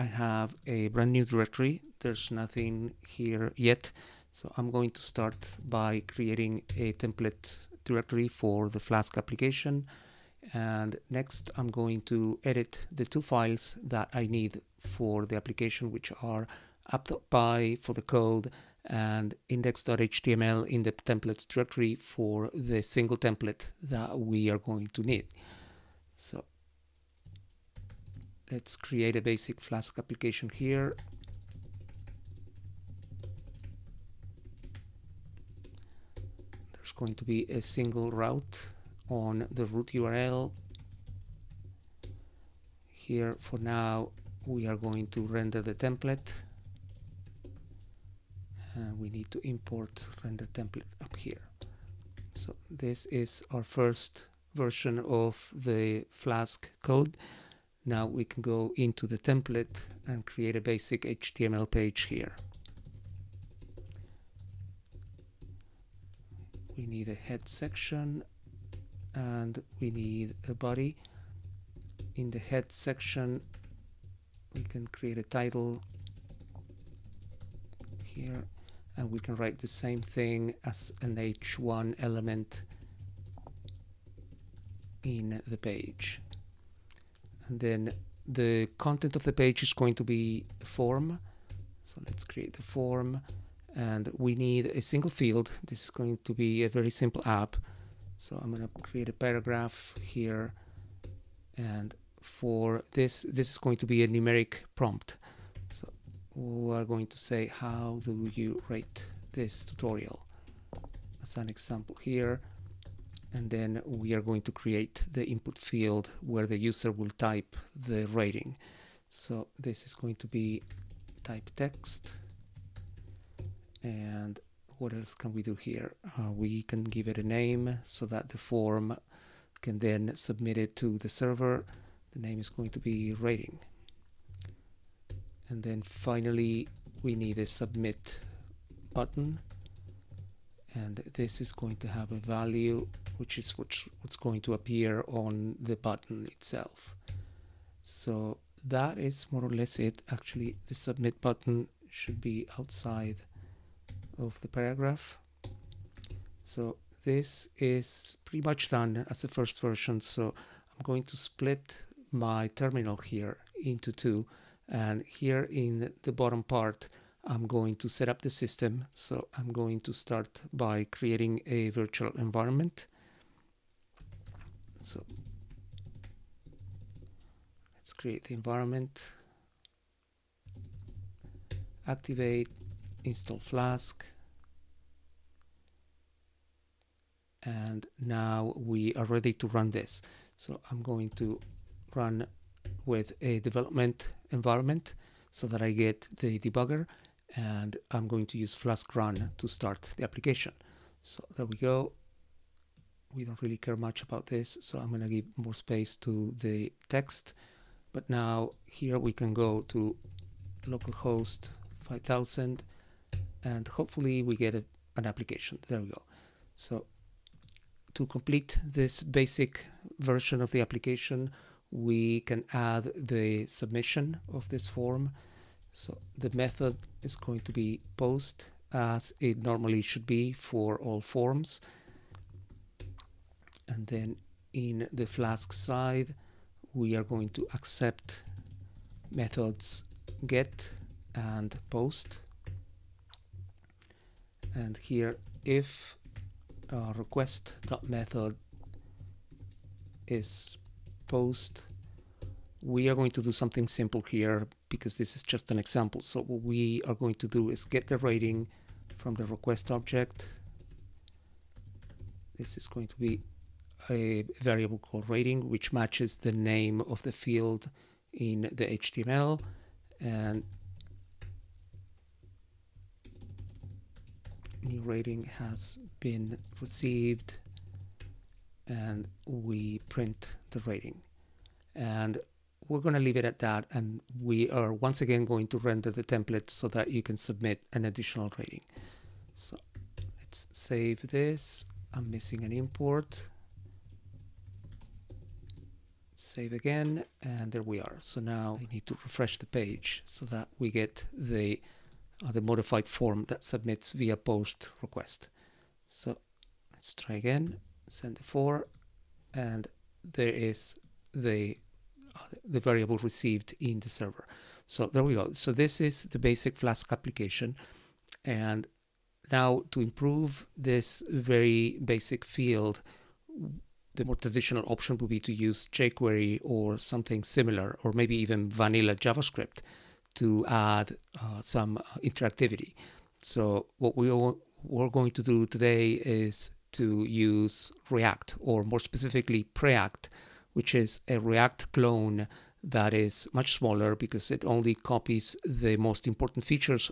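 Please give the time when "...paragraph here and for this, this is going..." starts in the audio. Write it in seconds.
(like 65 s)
99 s.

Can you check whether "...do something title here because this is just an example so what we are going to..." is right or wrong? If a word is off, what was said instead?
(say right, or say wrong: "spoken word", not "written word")
wrong: "simple", not "title".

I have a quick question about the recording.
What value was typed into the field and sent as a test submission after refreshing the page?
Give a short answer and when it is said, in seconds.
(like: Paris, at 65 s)
4, at 308 s.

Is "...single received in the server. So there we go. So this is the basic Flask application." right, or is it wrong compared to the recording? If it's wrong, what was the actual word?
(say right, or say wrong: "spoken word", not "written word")
wrong: "variable", not "single".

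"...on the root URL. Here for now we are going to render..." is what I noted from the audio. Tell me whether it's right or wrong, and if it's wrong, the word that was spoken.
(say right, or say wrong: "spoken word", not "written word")
right.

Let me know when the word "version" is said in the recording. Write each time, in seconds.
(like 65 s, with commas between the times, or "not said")
54 s, 159 s, 219 s.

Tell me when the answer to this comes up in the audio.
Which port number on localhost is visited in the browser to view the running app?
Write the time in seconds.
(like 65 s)
210 s.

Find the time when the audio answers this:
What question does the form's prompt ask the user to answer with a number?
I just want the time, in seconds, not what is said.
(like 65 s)
107 s.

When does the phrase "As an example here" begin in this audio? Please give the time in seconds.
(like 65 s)
111 s.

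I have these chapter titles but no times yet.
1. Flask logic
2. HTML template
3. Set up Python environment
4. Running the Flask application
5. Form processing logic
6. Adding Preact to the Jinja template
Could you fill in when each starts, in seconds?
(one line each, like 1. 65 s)
1. 25 s
2. 57 s
3. 156 s
4. 187 s
5. 216 s
6. 315 s.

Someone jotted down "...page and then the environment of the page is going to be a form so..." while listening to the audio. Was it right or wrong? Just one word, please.
wrong.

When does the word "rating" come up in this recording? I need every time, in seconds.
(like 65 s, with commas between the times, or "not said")
118 s, 133 s, 257 s, 265 s, 274 s, 280 s, 288 s.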